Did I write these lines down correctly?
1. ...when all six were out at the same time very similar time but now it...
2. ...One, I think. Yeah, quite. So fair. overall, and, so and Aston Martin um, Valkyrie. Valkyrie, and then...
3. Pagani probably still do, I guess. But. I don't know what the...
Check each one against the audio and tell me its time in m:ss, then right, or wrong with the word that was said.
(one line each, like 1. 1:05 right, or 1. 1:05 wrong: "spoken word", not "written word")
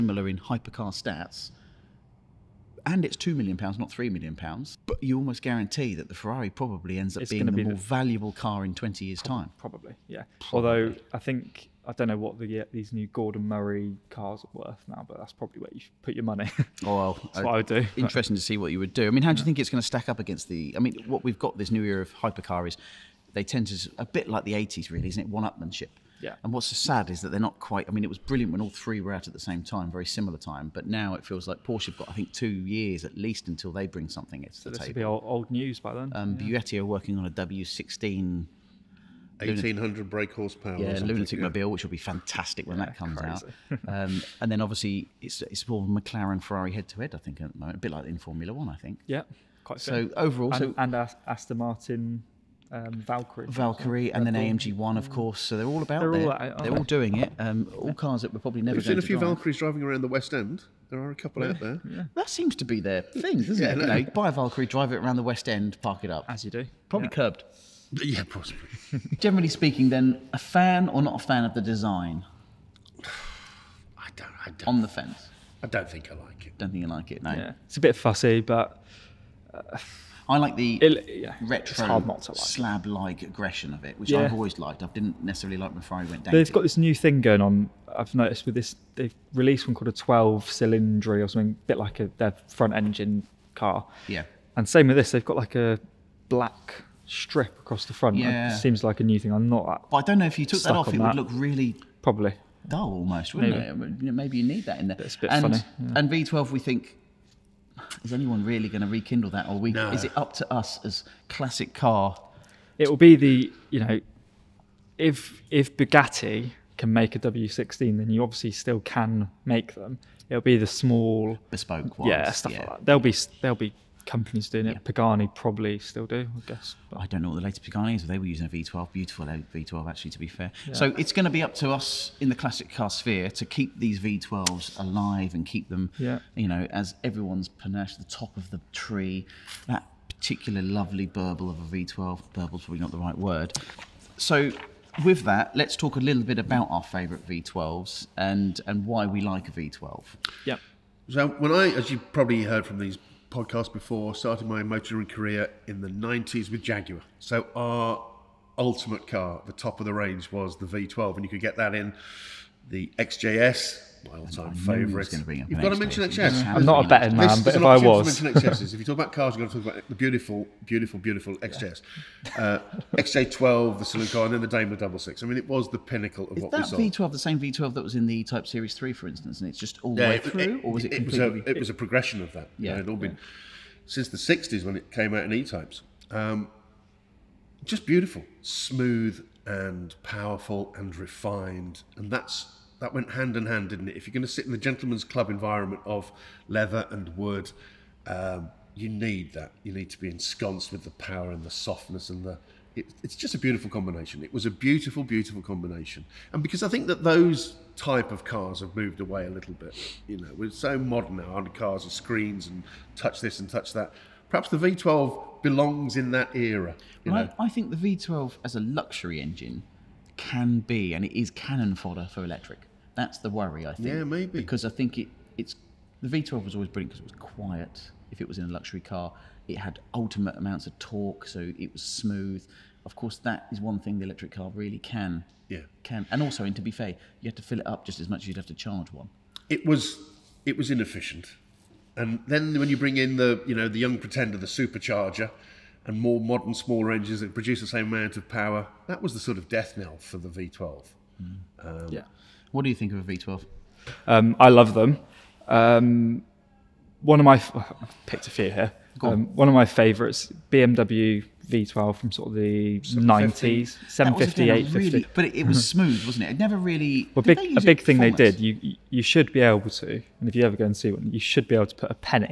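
1. 0:28 wrong: "three", not "six"
2. 0:48 right
3. 2:04 right.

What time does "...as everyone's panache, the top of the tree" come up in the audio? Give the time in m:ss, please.
2:16.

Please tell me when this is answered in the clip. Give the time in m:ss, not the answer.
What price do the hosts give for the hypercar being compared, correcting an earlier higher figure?
0:03.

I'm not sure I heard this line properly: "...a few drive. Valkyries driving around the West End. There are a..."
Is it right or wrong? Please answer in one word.
right.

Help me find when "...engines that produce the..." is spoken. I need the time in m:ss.
4:06.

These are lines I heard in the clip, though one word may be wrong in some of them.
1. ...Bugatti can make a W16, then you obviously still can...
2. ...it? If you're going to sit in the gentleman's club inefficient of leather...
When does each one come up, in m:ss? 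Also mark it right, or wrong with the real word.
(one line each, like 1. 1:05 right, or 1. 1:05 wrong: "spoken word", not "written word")
1. 1:55 right
2. 3:13 wrong: "environment", not "inefficient".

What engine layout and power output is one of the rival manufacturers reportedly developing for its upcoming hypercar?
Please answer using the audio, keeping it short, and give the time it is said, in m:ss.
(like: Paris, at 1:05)
W16 1800 brake horsepower, at 0:37.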